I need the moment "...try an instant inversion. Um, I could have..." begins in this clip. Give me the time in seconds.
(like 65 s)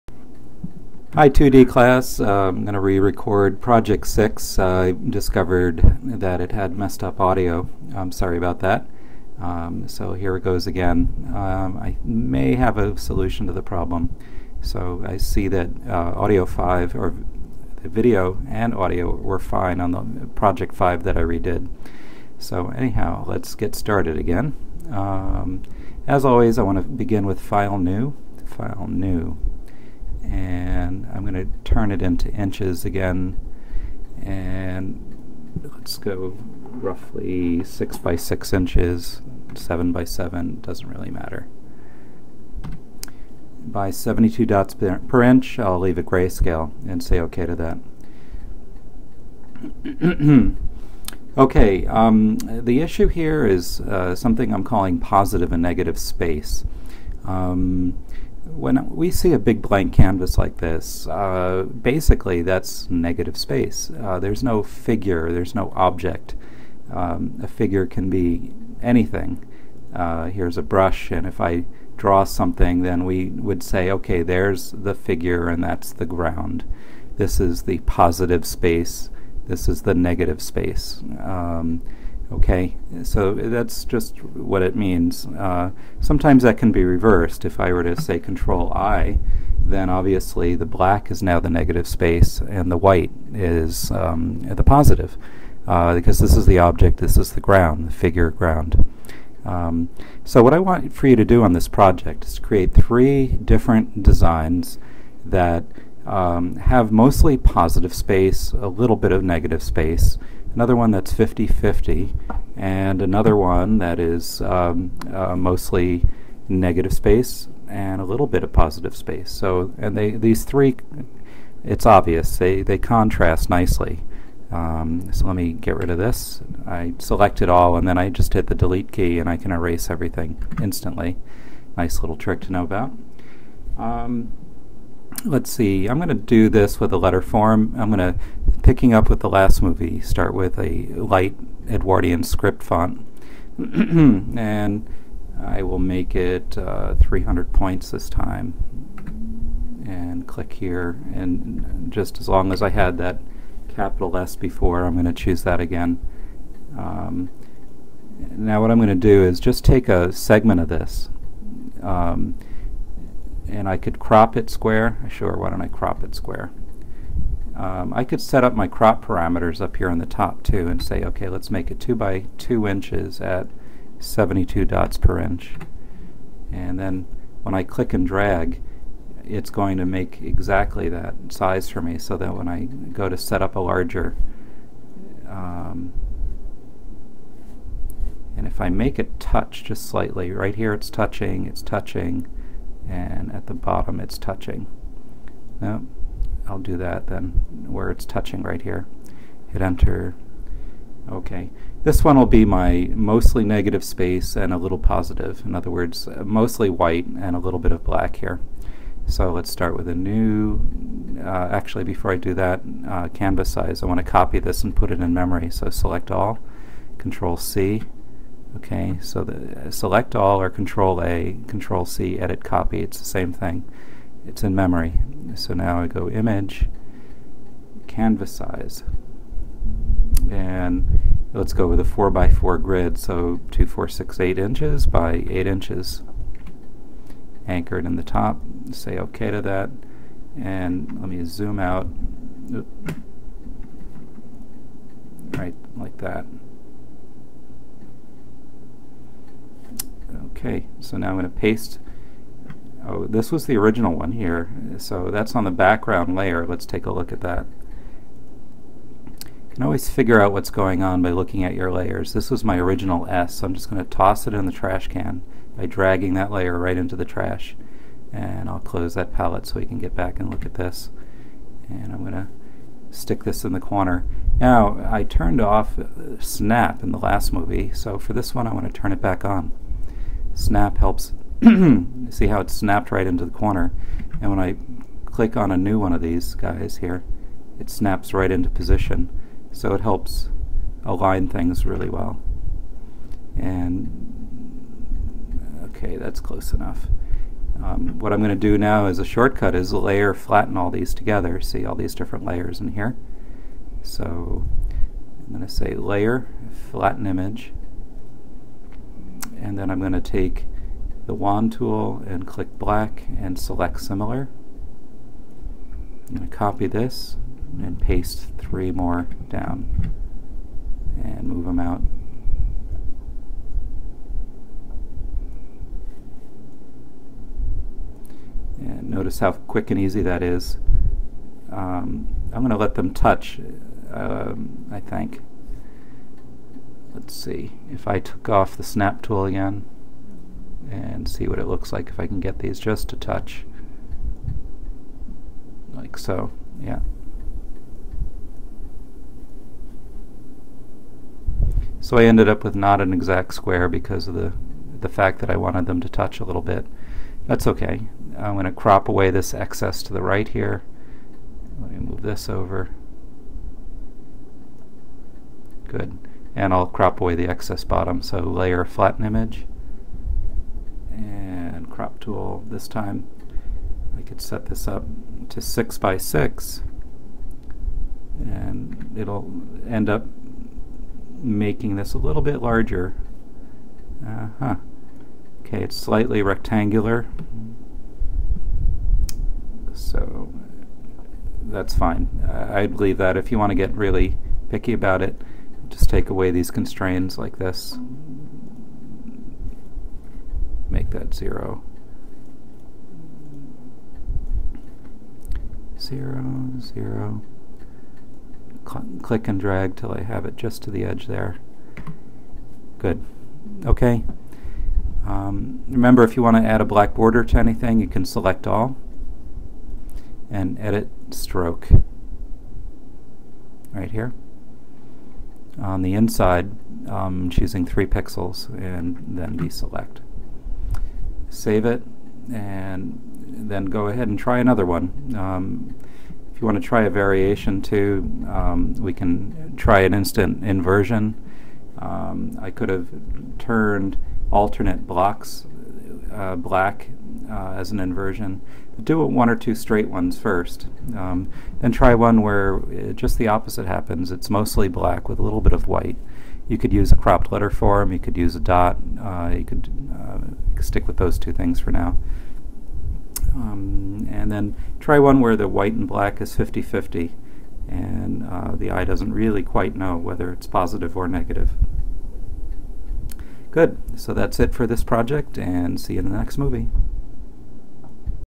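439 s.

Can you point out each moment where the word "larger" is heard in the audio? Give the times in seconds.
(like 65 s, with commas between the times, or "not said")
183 s, 382 s.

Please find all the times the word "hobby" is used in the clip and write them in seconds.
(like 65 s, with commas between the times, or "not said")
not said.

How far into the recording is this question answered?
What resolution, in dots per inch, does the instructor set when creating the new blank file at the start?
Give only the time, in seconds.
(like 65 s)
43 s.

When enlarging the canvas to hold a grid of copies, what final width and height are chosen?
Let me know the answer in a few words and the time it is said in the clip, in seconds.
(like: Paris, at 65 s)
8 by 8 inches, at 234 s.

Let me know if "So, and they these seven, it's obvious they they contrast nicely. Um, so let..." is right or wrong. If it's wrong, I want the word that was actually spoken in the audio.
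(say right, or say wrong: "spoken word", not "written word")
wrong: "three", not "seven".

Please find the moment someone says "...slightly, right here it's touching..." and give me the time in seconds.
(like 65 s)
189 s.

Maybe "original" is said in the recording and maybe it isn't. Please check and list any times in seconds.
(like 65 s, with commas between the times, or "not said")
253 s, 262 s.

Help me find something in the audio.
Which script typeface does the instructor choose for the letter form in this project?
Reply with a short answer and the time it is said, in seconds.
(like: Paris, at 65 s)
Light Edwardian script, at 140 s.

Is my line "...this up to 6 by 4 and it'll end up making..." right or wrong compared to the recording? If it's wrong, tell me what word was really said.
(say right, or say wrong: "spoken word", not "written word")
wrong: "6", not "4".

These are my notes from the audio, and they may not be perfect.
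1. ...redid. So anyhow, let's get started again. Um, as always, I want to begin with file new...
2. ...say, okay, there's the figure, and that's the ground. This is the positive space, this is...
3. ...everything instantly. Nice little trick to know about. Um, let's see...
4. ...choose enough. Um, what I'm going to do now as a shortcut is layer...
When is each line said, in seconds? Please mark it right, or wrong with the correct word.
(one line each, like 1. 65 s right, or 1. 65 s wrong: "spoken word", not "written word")
1. 21 s right
2. 73 s right
3. 129 s right
4. 296 s wrong: "close", not "choose".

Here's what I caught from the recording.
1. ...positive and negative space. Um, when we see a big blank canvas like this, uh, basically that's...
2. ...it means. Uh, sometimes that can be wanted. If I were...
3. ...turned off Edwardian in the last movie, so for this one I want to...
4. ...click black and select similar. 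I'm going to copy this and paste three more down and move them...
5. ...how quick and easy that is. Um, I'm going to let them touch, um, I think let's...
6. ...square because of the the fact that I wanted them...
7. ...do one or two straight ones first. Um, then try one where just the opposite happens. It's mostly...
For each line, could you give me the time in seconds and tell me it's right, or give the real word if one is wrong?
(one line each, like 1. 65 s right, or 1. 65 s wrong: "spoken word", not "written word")
1. 54 s right
2. 84 s wrong: "reversed", not "wanted"
3. 275 s wrong: "Snap", not "Edwardian"
4. 312 s right
5. 329 s right
6. 353 s right
7. 448 s right.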